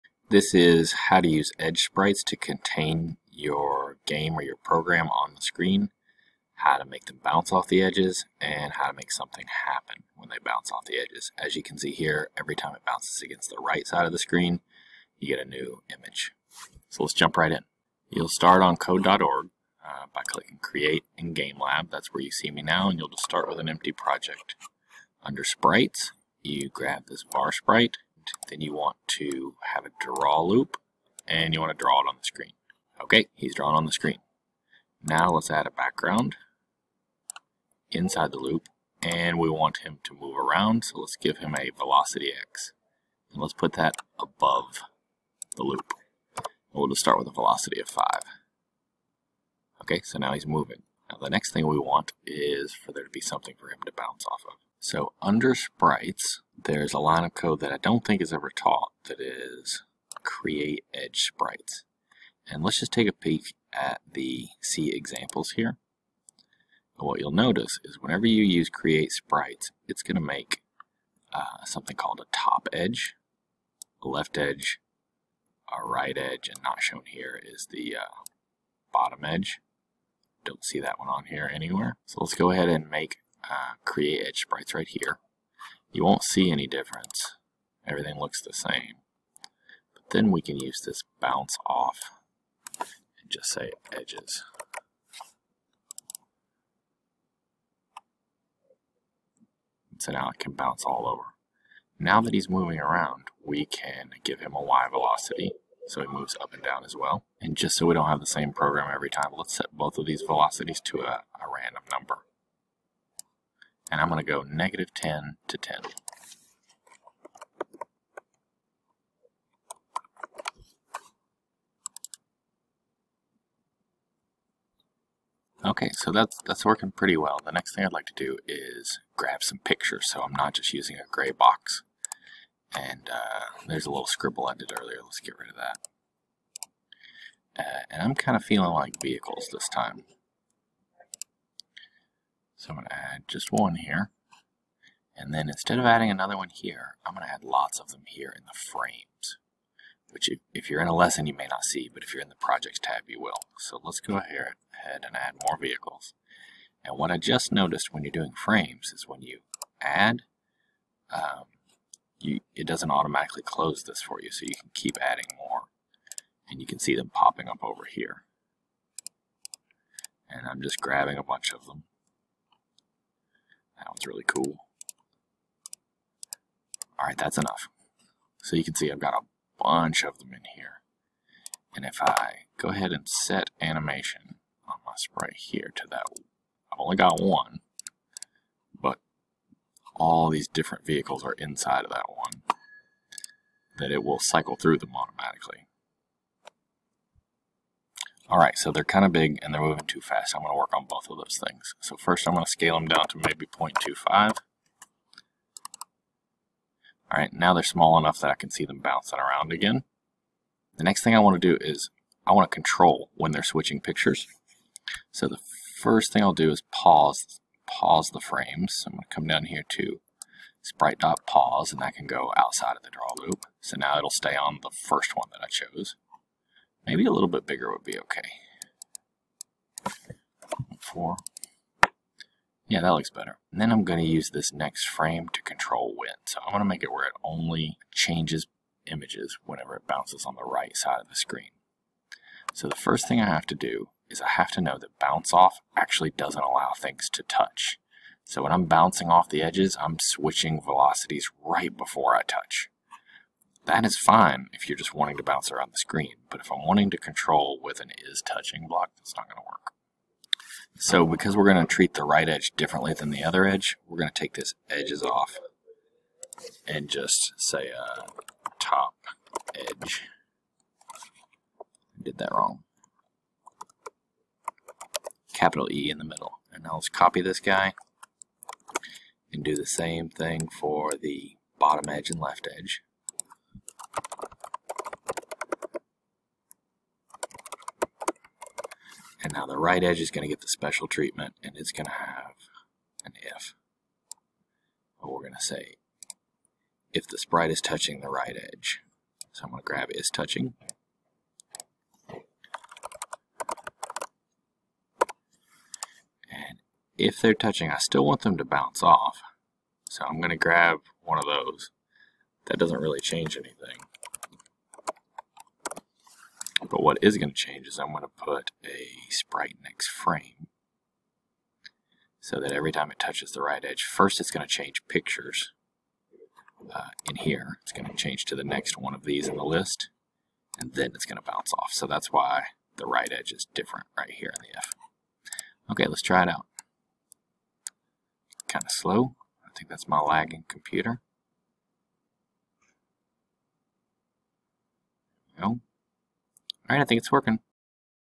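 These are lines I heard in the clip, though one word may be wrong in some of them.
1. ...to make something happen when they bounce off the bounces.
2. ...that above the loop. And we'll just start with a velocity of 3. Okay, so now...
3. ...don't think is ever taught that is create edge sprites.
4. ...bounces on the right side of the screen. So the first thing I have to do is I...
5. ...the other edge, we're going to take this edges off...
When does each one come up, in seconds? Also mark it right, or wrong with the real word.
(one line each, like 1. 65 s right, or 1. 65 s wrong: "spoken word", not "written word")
1. 8 s wrong: "edges", not "bounces"
2. 43 s wrong: "5", not "3"
3. 57 s right
4. 239 s right
5. 263 s right.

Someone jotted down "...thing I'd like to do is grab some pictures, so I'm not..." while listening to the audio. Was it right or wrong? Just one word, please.
right.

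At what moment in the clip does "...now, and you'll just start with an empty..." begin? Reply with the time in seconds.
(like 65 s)
22 s.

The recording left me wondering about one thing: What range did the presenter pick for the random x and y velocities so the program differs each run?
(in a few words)
-10 to 10.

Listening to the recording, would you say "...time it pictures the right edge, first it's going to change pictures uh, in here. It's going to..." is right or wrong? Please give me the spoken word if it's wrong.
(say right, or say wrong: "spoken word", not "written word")
wrong: "touches", not "pictures".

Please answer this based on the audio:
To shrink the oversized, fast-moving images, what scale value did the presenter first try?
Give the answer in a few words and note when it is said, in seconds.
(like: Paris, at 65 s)
0.25, at 203 s.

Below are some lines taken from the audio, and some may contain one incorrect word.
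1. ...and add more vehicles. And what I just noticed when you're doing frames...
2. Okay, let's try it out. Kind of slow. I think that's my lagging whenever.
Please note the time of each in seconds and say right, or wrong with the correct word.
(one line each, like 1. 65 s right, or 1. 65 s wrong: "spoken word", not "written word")
1. 155 s right
2. 335 s wrong: "computer", not "whenever".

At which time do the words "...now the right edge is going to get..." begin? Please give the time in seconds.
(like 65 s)
289 s.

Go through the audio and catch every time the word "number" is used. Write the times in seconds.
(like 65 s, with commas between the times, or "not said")
111 s.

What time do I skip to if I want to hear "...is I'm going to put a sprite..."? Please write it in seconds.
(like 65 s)
317 s.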